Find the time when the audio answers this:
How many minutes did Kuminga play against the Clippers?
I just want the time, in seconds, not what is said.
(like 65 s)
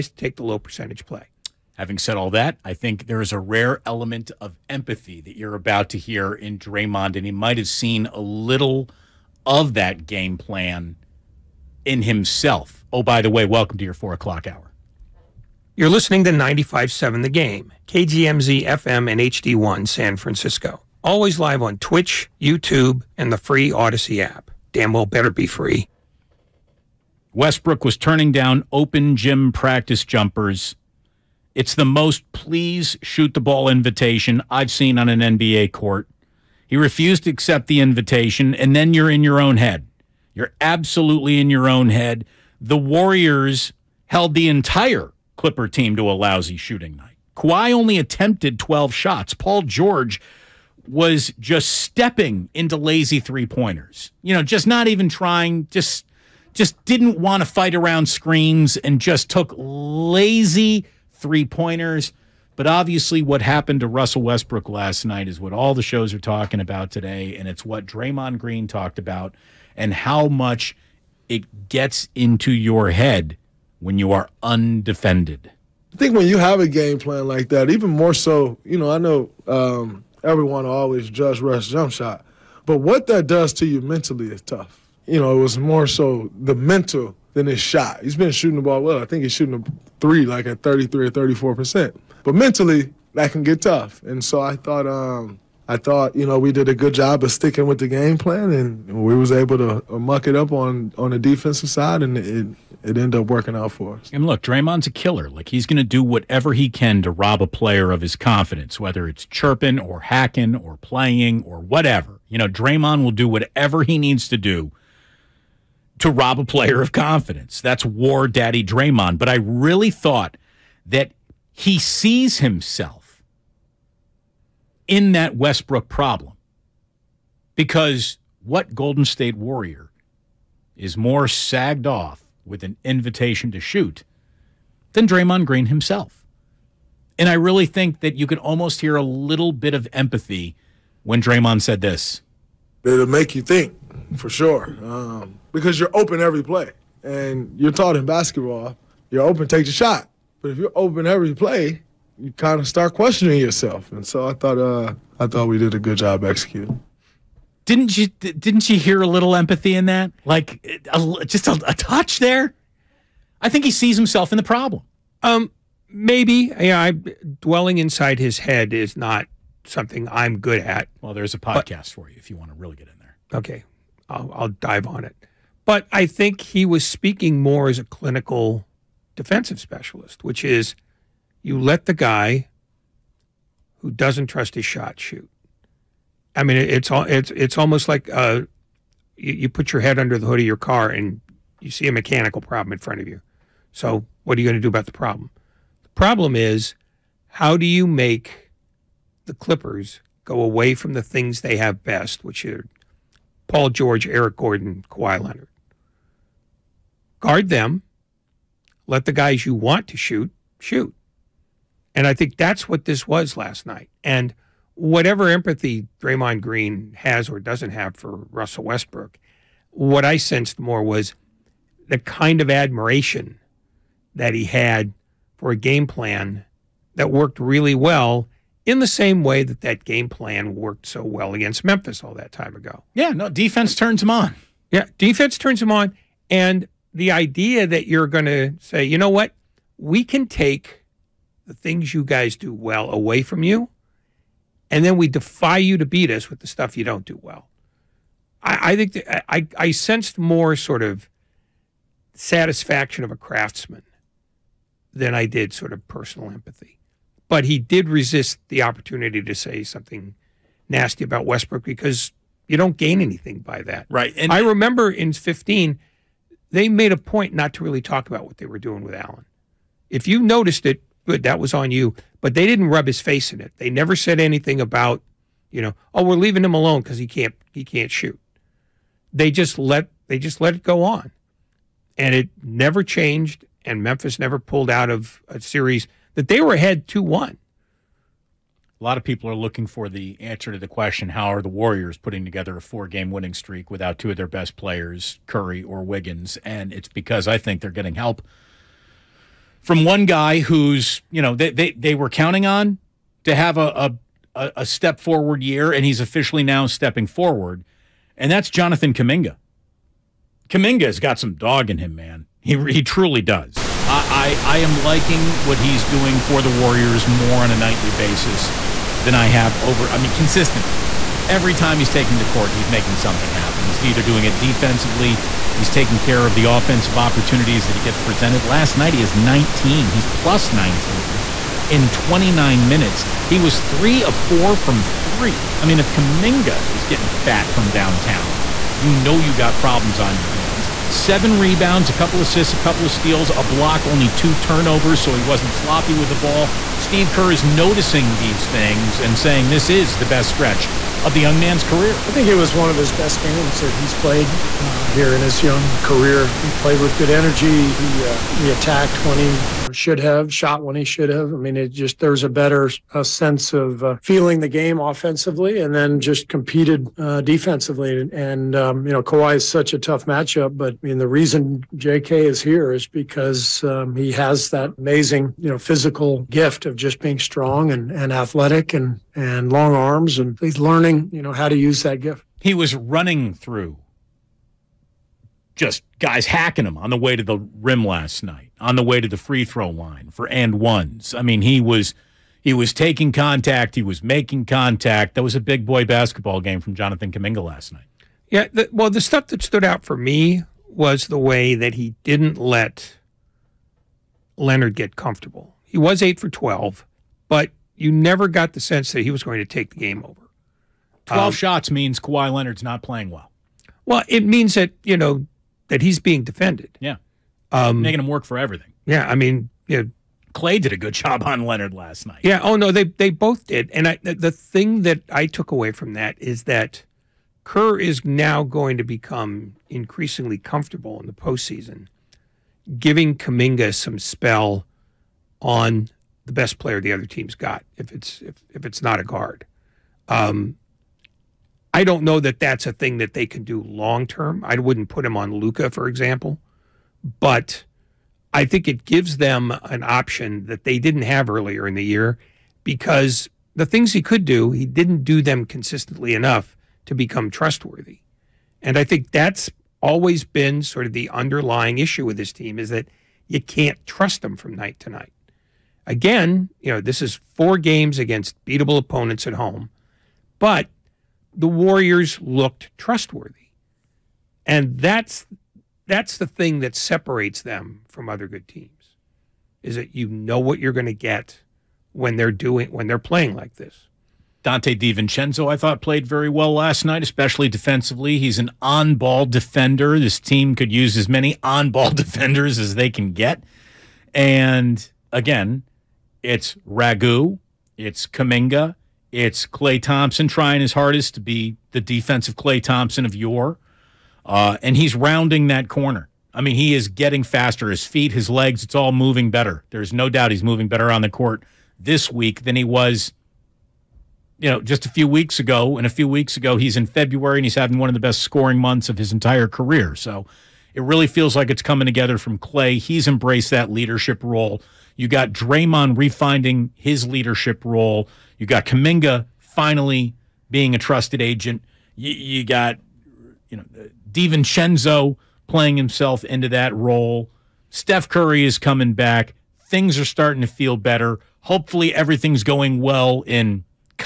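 331 s.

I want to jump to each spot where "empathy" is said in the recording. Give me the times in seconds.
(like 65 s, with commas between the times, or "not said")
4 s, 139 s, 159 s, 215 s, 256 s.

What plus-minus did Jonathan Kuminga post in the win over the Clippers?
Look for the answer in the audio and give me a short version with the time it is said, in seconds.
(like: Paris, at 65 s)
+19, at 330 s.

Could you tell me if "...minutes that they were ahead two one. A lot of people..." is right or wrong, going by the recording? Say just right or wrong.
wrong.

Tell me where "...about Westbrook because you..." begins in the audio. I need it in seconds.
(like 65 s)
261 s.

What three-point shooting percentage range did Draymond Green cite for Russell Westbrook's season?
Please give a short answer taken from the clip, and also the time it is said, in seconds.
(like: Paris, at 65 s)
33 or 34 percent, at 90 s.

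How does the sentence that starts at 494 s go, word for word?
And again, it's Ragu, it's Kuminga, it's Klay Thompson trying his hardest to be the defensive Klay Thompson of yore.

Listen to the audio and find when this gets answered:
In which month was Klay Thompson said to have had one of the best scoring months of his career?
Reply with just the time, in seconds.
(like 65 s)
516 s.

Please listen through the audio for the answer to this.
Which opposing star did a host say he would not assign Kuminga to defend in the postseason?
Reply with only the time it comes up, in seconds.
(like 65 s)
445 s.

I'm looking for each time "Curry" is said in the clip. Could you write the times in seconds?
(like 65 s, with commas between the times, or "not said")
295 s, 538 s.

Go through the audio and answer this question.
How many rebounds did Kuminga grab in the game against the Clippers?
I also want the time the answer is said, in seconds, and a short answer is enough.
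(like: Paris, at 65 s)
7, at 340 s.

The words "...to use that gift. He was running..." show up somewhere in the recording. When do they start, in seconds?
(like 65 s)
381 s.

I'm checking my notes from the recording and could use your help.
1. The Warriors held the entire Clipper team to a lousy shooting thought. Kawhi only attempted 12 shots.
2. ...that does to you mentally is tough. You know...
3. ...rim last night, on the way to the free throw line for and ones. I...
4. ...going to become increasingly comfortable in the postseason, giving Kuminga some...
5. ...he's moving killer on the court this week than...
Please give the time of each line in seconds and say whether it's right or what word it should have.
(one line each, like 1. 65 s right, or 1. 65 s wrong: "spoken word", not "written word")
1. 42 s wrong: "night", not "thought"
2. 83 s right
3. 387 s right
4. 428 s right
5. 510 s wrong: "better", not "killer".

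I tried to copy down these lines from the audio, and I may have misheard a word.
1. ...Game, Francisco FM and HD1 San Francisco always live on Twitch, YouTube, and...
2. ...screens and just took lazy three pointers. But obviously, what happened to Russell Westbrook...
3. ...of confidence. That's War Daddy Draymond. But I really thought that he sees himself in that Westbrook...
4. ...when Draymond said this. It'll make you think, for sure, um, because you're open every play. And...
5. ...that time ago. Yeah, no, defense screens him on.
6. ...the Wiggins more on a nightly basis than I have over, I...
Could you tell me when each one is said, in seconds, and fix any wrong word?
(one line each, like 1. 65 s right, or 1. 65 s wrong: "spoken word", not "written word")
1. 17 s wrong: "KGMZ", not "Francisco"
2. 58 s right
3. 116 s right
4. 141 s right
5. 232 s wrong: "turns", not "screens"
6. 316 s wrong: "Warriors", not "Wiggins".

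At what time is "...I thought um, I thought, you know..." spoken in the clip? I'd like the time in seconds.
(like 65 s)
94 s.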